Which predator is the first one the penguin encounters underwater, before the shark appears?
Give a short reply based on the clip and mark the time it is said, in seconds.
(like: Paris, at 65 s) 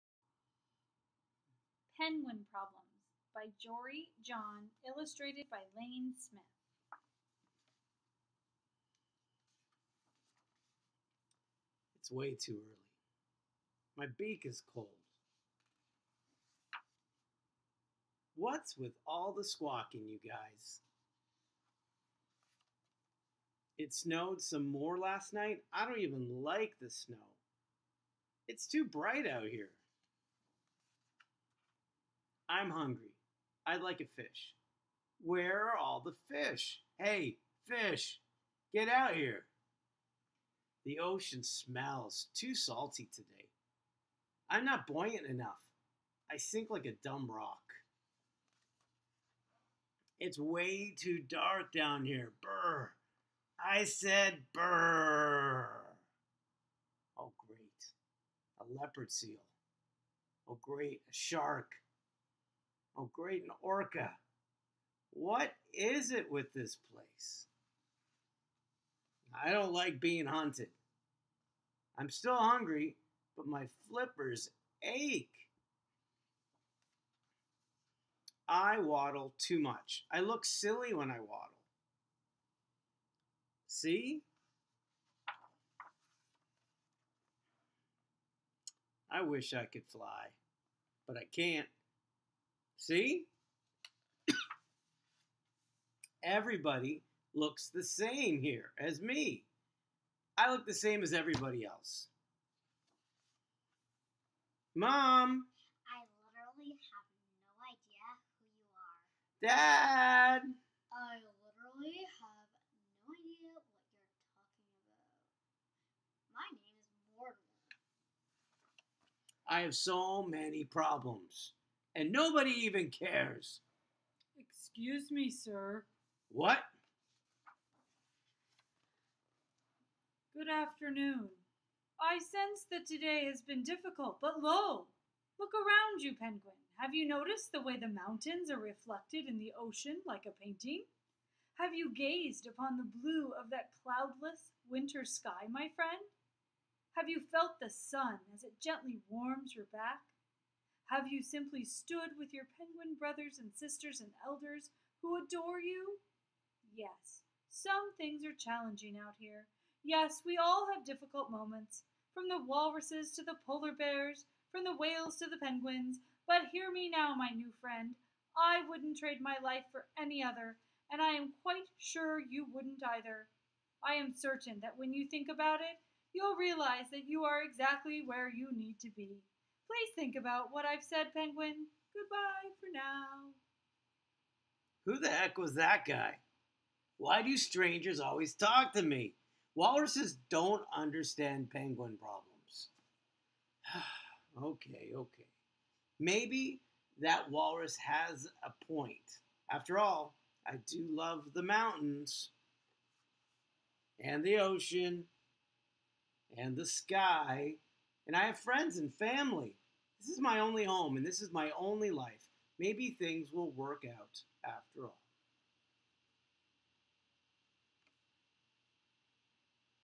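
Leopard seal, at 58 s.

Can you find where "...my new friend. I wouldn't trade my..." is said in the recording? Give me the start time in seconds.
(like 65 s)
167 s.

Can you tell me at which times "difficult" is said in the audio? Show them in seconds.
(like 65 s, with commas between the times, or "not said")
133 s, 160 s.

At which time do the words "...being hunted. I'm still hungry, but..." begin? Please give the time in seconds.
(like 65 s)
70 s.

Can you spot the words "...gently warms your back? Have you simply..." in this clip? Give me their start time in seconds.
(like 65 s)
148 s.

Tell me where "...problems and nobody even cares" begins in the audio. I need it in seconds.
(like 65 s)
120 s.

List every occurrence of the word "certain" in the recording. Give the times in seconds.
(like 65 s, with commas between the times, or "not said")
174 s.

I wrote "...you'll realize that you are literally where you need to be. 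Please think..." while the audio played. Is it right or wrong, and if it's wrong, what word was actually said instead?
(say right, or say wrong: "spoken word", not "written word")
wrong: "exactly", not "literally".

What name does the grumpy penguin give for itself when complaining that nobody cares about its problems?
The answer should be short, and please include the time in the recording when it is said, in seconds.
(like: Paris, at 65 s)
Mortimer, at 117 s.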